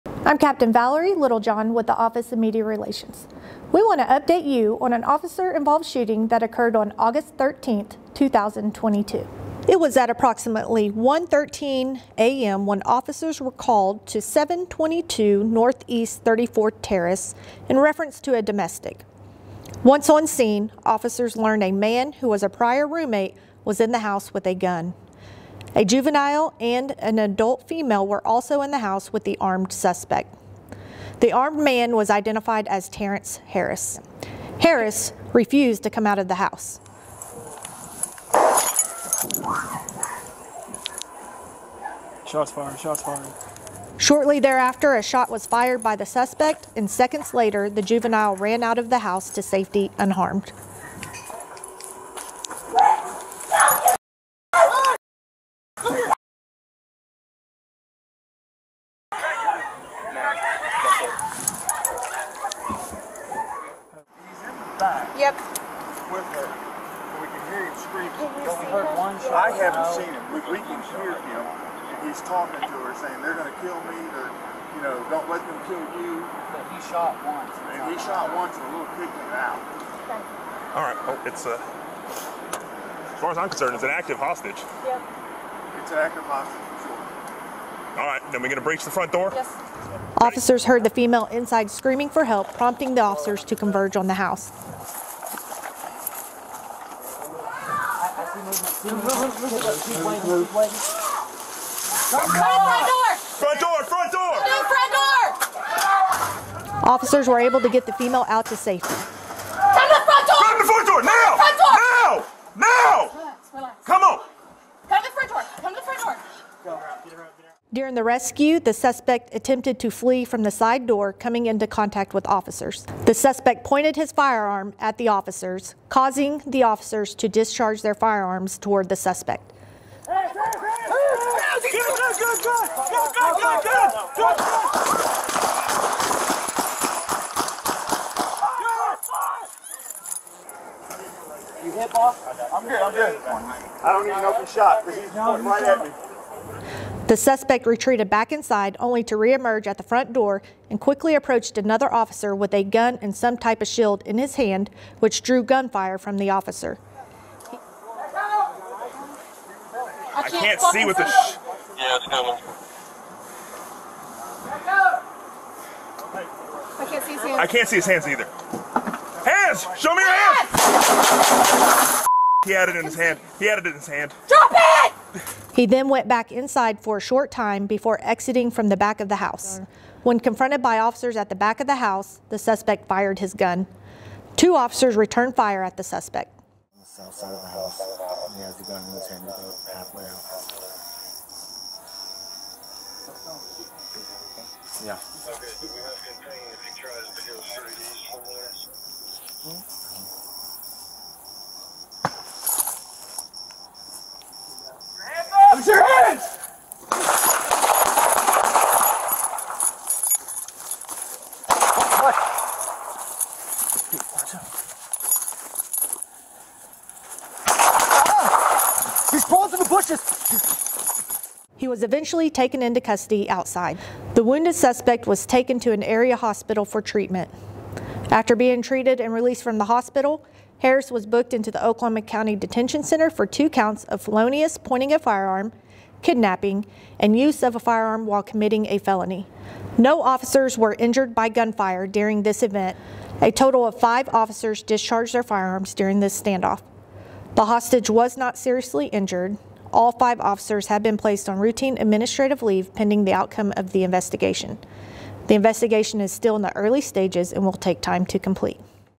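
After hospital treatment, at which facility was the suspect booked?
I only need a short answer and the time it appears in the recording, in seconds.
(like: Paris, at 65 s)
Oklahoma County Detention Center, at 231 s.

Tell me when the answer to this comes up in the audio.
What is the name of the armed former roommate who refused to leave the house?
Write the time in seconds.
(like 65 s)
32 s.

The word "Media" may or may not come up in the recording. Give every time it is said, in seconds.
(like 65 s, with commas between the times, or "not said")
2 s.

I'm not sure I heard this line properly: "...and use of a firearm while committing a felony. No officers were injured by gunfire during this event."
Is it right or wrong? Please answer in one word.
right.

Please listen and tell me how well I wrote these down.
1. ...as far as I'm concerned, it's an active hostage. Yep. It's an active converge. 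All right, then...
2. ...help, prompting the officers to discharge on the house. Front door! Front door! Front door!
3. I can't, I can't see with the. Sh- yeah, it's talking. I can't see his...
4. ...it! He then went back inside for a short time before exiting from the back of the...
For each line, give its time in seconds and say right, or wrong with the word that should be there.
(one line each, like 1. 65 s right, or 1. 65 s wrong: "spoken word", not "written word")
1. 83 s wrong: "hostage", not "converge"
2. 92 s wrong: "converge", not "discharge"
3. 160 s wrong: "coming", not "talking"
4. 174 s right.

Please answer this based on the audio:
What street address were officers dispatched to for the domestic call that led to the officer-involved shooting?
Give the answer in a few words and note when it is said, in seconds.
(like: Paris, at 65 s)
722 Northeast 34th Terrace, at 14 s.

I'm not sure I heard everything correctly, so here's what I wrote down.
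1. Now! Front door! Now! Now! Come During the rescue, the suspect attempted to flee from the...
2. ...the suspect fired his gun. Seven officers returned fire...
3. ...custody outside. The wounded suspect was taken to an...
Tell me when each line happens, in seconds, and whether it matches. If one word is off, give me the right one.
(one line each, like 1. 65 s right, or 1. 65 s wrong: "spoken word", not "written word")
1. 111 s right
2. 182 s wrong: "Two", not "Seven"
3. 222 s right.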